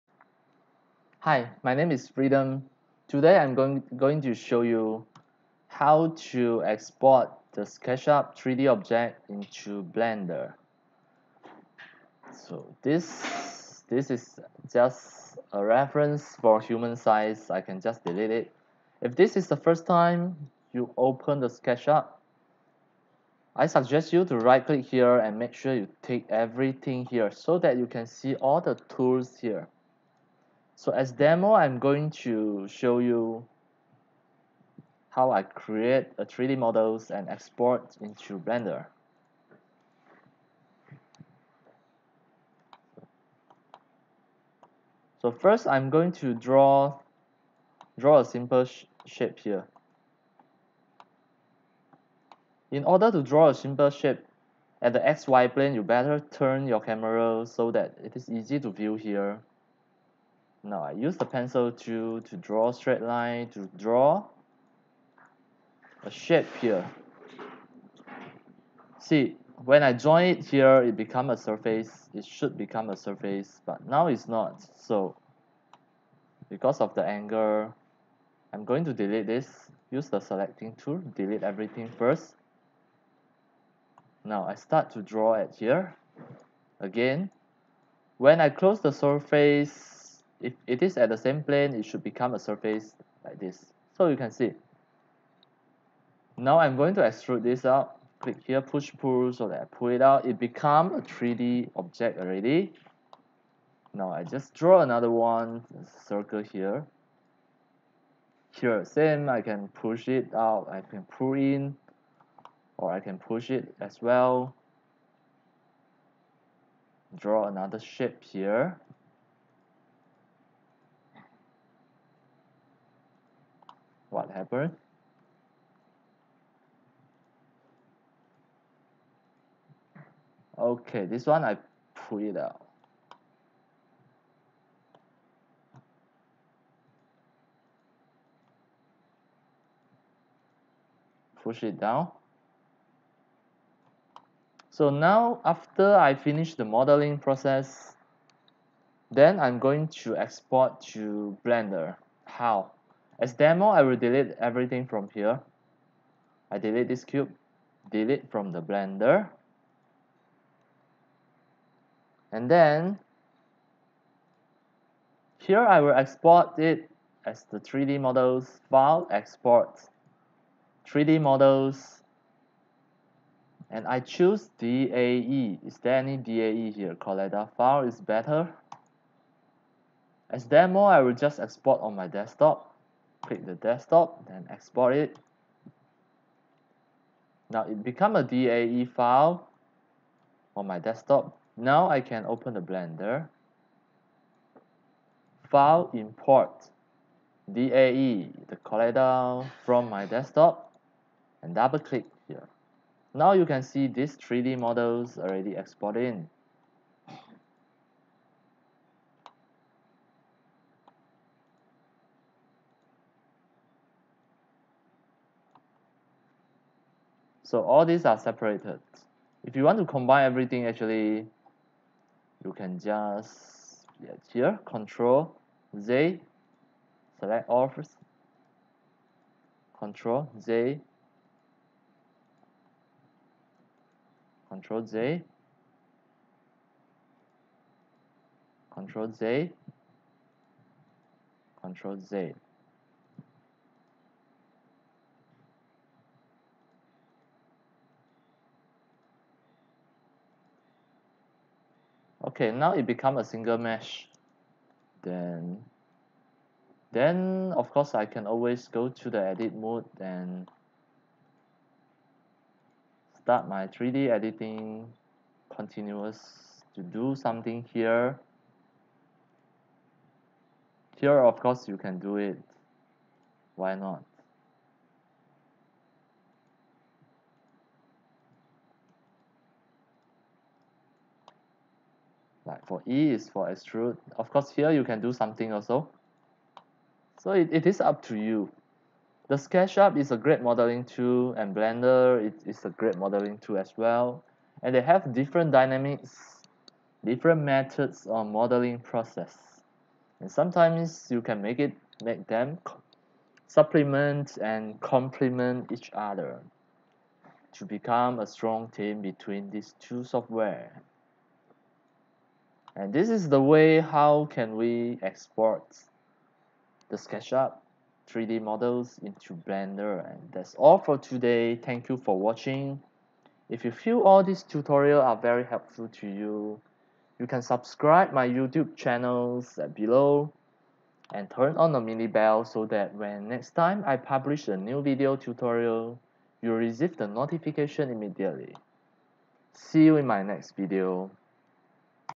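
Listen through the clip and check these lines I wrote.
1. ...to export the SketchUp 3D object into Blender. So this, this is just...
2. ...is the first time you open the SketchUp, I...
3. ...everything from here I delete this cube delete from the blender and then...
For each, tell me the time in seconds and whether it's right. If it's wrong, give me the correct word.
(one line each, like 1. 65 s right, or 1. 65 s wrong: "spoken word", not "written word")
1. 6 s right
2. 19 s right
3. 154 s right.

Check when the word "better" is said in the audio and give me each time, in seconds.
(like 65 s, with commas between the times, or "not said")
55 s, 178 s.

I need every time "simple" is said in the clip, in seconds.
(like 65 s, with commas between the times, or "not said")
48 s, 53 s.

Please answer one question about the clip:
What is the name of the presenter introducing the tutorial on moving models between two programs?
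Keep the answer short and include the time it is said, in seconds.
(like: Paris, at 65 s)
Freedom, at 2 s.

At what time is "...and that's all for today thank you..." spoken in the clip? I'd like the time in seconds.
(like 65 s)
320 s.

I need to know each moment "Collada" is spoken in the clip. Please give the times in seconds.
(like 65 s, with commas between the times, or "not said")
176 s, 198 s.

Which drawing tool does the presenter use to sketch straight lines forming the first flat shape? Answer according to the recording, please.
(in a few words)
pencil.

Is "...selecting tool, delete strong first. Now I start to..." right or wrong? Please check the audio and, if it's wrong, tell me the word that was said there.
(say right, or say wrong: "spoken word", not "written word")
wrong: "everything", not "strong".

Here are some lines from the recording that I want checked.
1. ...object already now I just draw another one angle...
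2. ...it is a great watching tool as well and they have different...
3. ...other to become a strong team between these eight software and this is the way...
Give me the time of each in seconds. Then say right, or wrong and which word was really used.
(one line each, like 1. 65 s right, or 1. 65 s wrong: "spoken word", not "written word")
1. 101 s wrong: "circle", not "angle"
2. 292 s wrong: "modeling", not "watching"
3. 305 s wrong: "two", not "eight".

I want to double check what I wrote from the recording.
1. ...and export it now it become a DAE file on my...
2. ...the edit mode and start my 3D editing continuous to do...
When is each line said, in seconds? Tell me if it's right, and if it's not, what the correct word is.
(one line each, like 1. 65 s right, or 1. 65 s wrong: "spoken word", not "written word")
1. 184 s right
2. 259 s right.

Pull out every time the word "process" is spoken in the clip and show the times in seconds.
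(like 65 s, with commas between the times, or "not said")
147 s, 298 s.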